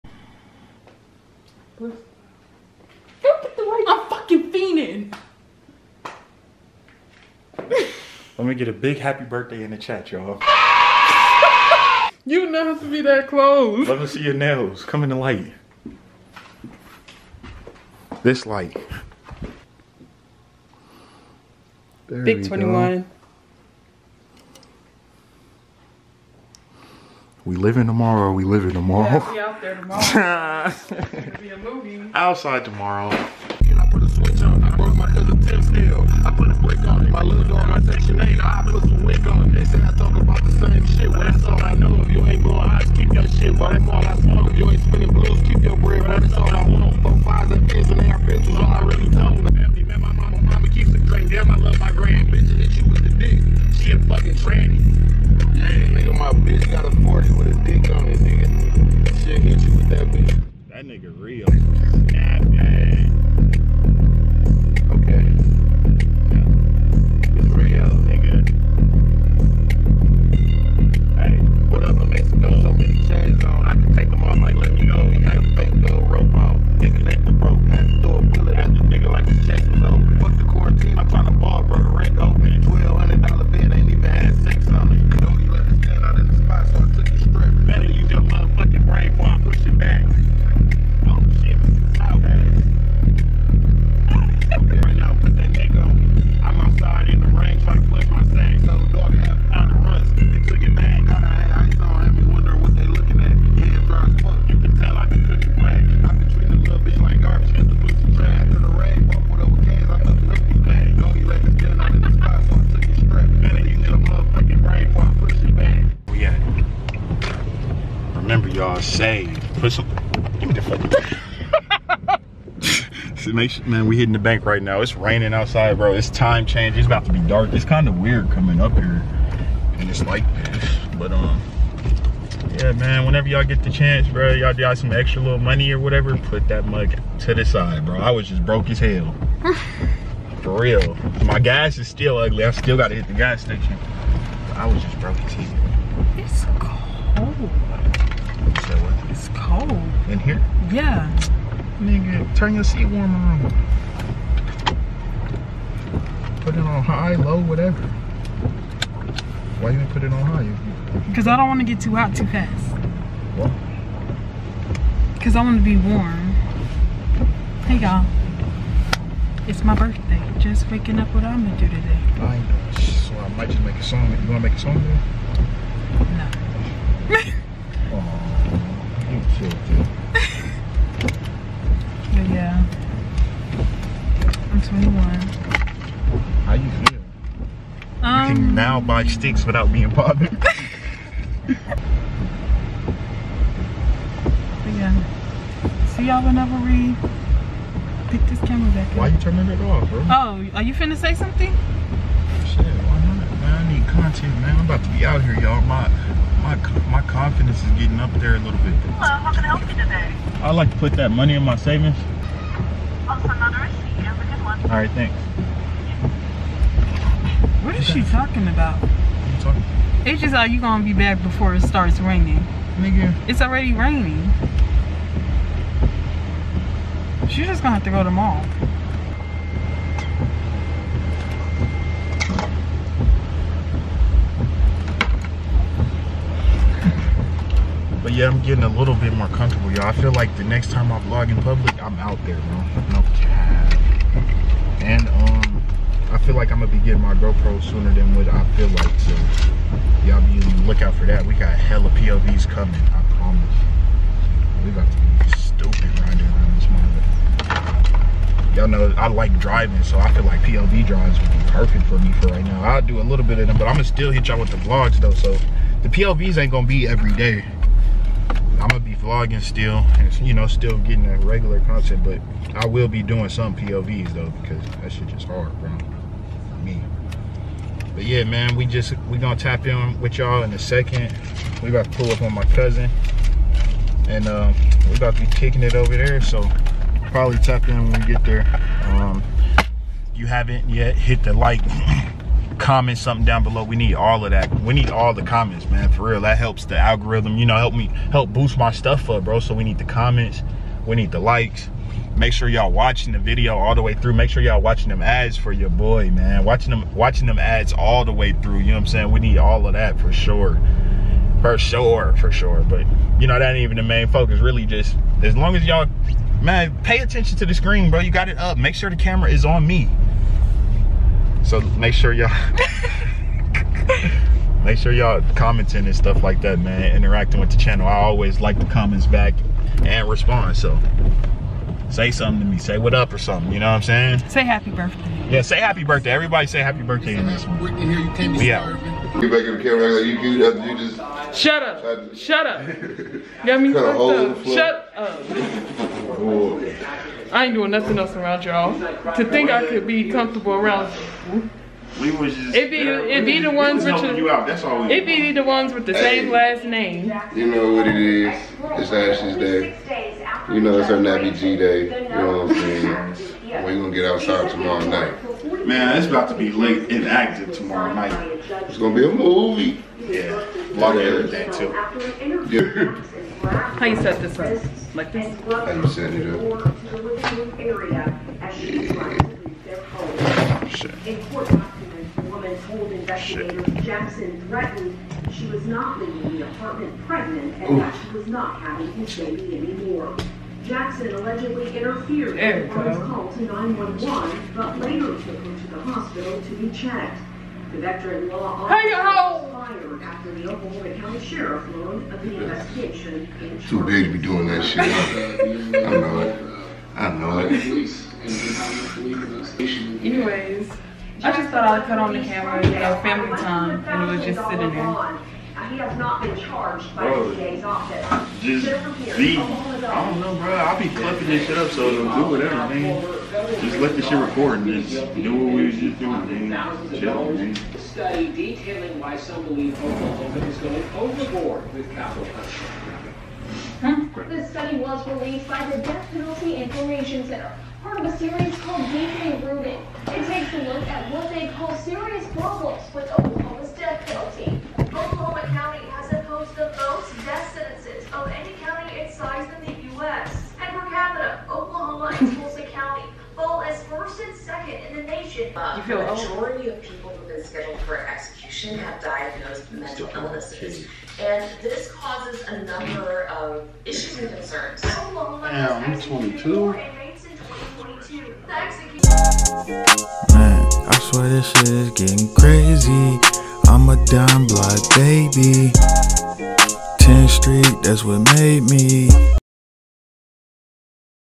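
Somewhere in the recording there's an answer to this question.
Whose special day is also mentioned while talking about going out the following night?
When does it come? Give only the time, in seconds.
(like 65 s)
358 s.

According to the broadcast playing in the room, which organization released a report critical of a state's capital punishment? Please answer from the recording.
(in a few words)
Death Penalty Information Center.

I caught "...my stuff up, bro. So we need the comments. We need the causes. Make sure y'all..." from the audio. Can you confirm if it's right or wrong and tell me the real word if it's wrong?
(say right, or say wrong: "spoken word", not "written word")
wrong: "likes", not "causes".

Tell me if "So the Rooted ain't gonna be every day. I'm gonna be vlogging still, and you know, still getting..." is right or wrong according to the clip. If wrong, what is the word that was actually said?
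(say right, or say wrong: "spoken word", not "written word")
wrong: "POVs", not "Rooted".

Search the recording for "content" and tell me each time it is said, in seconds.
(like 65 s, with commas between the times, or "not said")
203 s, 271 s.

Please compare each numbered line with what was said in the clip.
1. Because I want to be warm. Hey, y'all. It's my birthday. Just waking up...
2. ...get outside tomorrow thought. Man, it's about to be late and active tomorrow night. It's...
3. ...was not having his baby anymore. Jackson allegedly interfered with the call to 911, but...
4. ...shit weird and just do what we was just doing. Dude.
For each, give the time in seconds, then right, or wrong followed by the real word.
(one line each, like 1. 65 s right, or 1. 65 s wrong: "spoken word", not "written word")
1. 165 s right
2. 363 s wrong: "night", not "thought"
3. 388 s right
4. 424 s wrong: "record", not "weird".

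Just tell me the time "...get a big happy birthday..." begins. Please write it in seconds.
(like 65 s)
8 s.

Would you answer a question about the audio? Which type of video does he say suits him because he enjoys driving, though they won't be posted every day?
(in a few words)
POV drives.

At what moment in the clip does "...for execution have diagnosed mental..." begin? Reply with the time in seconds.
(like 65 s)
457 s.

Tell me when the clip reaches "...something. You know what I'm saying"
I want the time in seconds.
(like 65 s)
333 s.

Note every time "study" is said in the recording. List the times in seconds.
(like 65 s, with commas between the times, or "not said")
427 s, 434 s.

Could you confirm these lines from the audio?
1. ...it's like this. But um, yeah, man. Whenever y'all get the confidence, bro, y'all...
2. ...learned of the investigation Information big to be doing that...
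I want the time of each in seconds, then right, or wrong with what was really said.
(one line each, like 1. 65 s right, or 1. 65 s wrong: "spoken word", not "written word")
1. 129 s wrong: "chance", not "confidence"
2. 401 s wrong: "Too", not "Information".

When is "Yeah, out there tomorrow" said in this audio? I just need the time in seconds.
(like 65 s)
29 s.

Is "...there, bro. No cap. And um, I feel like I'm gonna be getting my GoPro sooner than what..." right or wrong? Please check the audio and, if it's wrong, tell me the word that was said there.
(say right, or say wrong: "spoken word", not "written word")
right.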